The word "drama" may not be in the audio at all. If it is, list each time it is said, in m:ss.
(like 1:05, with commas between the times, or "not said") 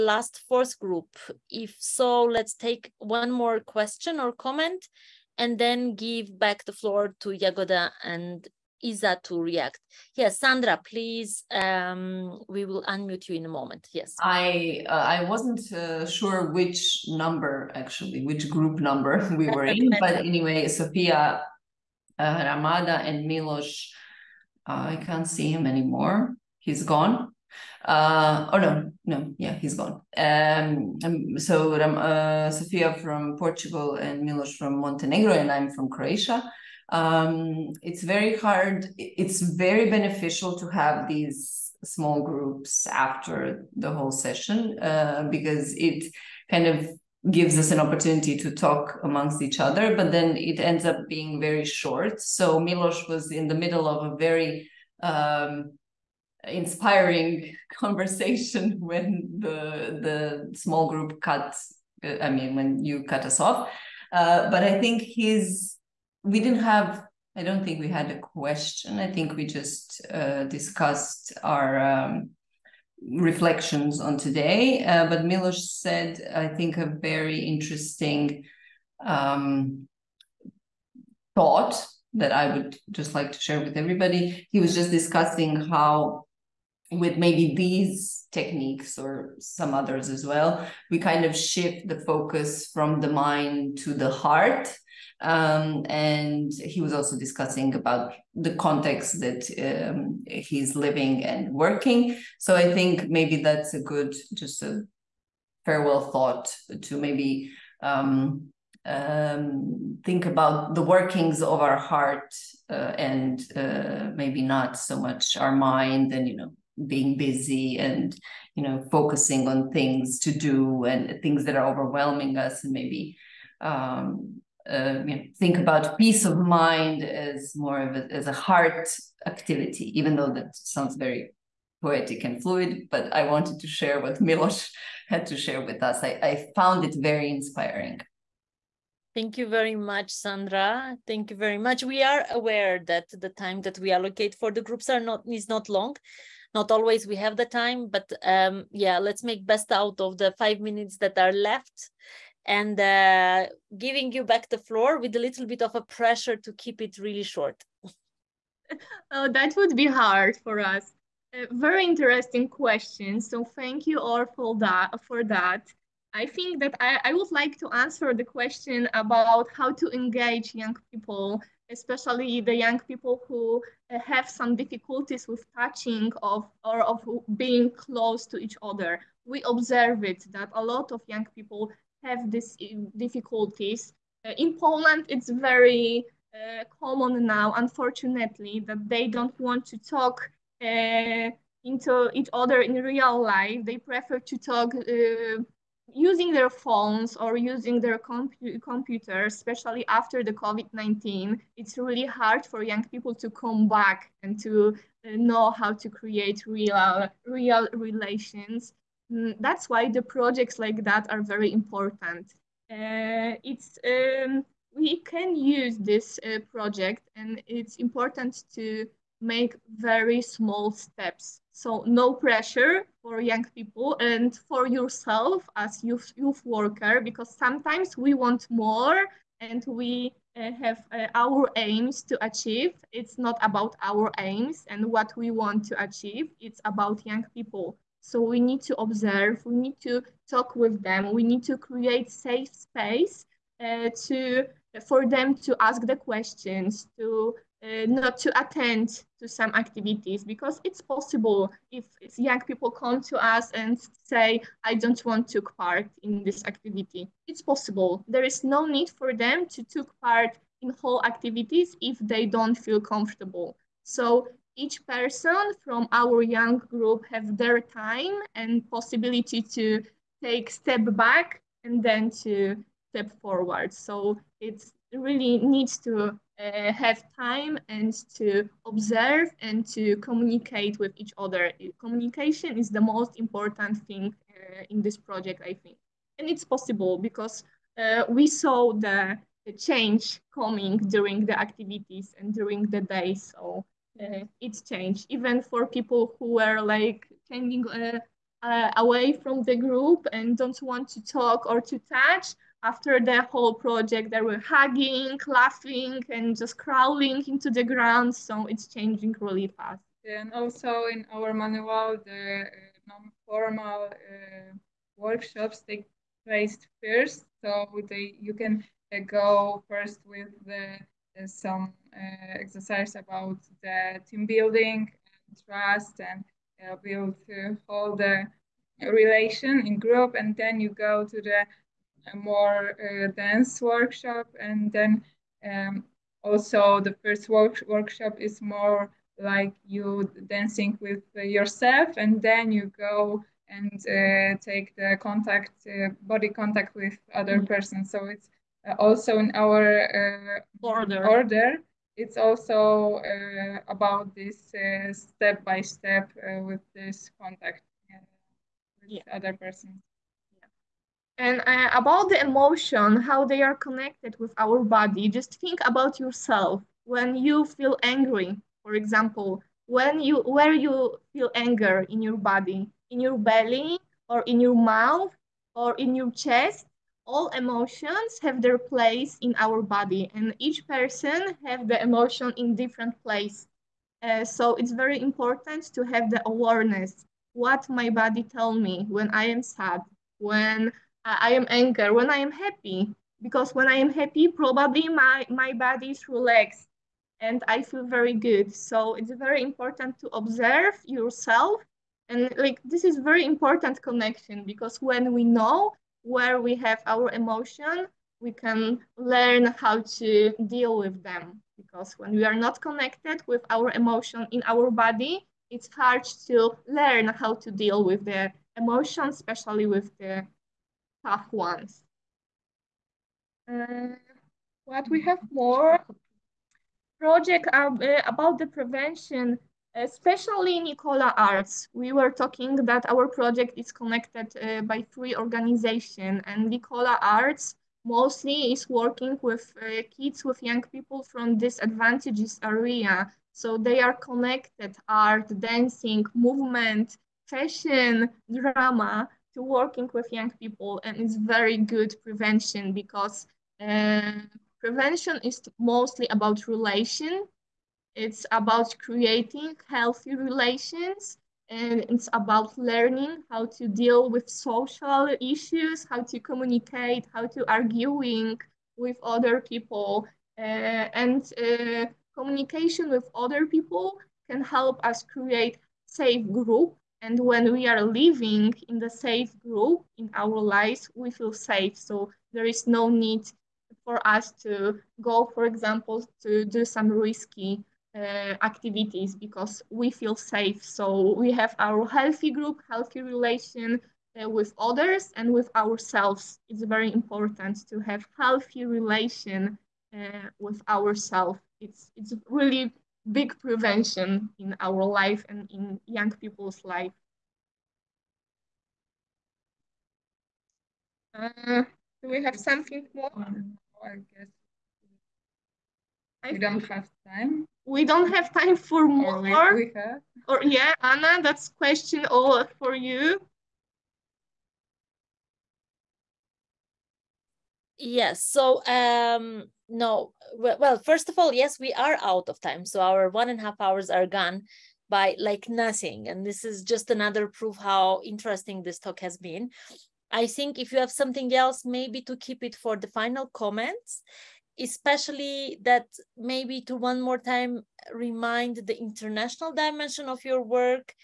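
7:28.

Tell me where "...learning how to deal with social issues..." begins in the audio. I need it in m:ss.
7:42.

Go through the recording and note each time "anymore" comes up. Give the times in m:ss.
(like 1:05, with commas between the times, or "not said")
0:25.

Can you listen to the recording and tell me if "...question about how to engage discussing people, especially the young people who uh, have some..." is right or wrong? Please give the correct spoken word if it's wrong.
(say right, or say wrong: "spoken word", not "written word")
wrong: "young", not "discussing".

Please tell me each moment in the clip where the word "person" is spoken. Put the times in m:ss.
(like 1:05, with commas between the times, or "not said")
4:24, 5:47, 5:59, 6:20.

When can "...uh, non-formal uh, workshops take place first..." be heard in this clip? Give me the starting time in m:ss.
5:12.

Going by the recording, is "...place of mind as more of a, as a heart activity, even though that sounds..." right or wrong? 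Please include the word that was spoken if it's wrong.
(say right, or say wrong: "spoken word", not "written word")
wrong: "peace", not "place".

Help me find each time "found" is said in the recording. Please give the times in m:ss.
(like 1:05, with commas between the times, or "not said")
2:16.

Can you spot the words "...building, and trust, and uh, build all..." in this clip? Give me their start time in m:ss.
5:24.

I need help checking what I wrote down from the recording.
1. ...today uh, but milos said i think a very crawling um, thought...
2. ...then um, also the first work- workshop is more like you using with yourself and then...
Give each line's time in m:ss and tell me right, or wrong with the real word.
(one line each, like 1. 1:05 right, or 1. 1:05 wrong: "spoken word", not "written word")
1. 1:14 wrong: "interesting", not "crawling"
2. 5:34 wrong: "dancing", not "using".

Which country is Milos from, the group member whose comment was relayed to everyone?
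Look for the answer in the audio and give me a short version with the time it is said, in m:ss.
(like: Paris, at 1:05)
Montenegro, at 0:34.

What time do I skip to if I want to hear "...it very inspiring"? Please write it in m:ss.
2:16.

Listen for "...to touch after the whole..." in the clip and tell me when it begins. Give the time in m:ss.
5:01.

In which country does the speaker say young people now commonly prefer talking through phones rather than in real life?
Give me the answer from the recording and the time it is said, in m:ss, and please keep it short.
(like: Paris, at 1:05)
Poland, at 3:04.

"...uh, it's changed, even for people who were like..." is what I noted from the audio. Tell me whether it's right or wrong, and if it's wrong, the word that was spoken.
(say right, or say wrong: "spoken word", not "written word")
right.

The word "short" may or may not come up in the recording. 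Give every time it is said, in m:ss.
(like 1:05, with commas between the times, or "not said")
0:51, 2:37.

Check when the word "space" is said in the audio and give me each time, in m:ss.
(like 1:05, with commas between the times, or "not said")
4:02.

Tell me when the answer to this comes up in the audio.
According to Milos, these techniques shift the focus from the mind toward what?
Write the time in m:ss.
1:33.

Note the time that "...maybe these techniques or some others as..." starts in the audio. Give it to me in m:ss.
1:27.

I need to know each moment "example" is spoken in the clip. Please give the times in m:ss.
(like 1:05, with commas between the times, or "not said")
6:08, 8:05.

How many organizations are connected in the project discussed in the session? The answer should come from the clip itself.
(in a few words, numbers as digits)
3.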